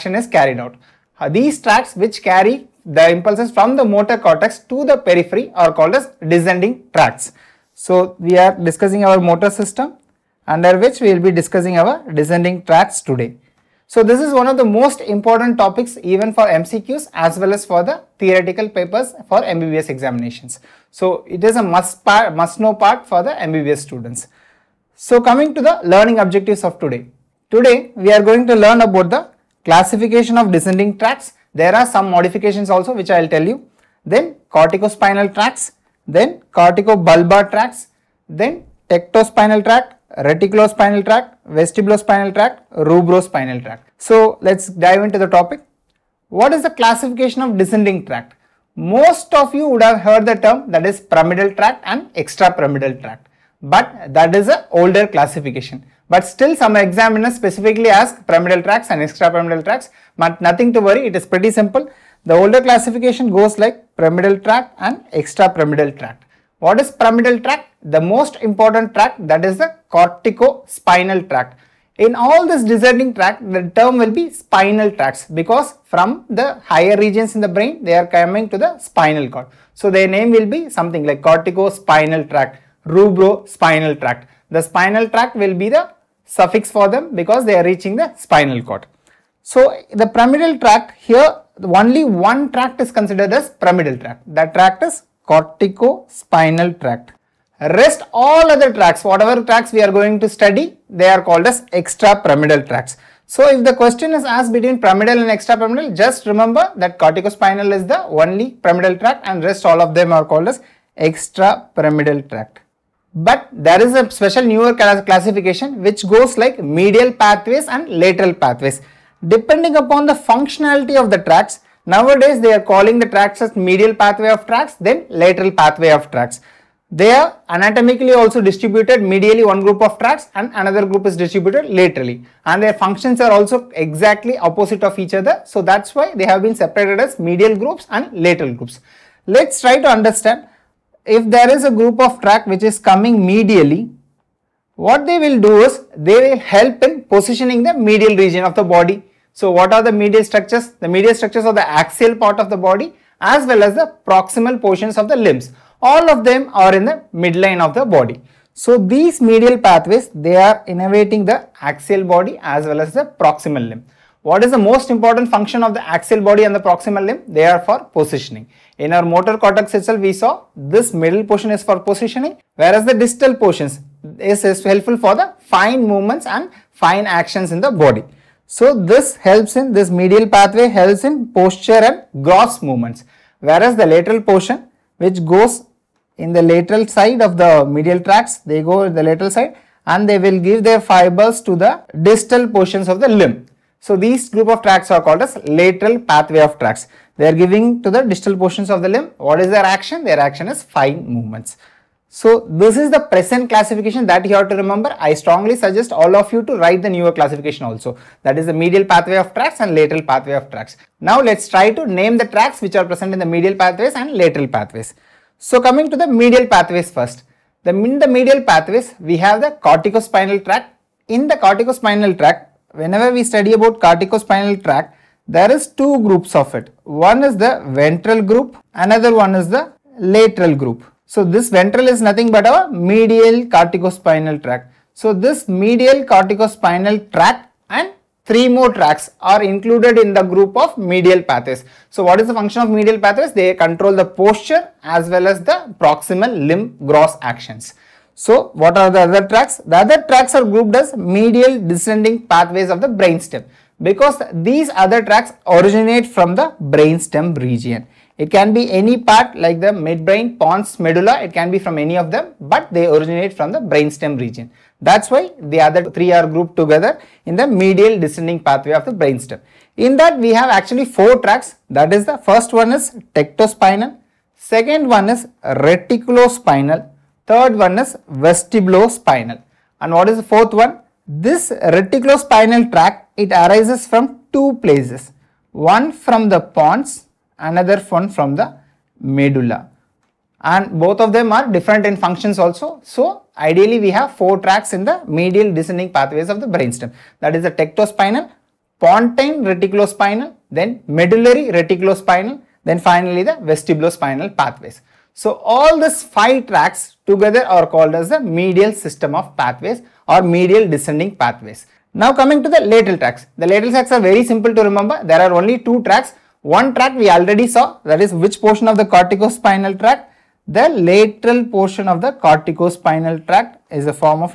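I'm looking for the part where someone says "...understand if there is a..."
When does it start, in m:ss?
2:19.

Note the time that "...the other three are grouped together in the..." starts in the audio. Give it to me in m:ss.
4:25.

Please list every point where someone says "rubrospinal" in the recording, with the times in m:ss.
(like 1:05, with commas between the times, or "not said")
0:42, 1:22.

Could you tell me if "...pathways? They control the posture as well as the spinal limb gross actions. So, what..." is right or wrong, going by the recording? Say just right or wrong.
wrong.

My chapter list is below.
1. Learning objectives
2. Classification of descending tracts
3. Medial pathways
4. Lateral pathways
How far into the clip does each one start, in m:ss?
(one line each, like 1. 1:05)
1. 0:25
2. 0:46
3. 3:34
4. 5:12.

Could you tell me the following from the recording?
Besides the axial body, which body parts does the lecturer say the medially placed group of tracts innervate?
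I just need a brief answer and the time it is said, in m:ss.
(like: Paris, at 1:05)
Proximal portions of the limbs, at 2:34.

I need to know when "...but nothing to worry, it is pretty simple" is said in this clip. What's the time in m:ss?
1:00.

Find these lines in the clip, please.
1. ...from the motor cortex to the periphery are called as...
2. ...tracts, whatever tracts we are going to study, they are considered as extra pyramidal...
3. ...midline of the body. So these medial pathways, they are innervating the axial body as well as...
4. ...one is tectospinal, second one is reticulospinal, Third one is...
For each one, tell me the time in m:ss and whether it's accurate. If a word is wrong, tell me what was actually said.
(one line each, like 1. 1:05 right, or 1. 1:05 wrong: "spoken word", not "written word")
1. 0:03 right
2. 1:38 wrong: "called", not "considered"
3. 2:37 right
4. 4:32 right.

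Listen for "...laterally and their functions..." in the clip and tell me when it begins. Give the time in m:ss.
2:11.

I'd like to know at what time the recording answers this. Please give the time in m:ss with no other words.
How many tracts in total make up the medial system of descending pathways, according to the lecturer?
5:06.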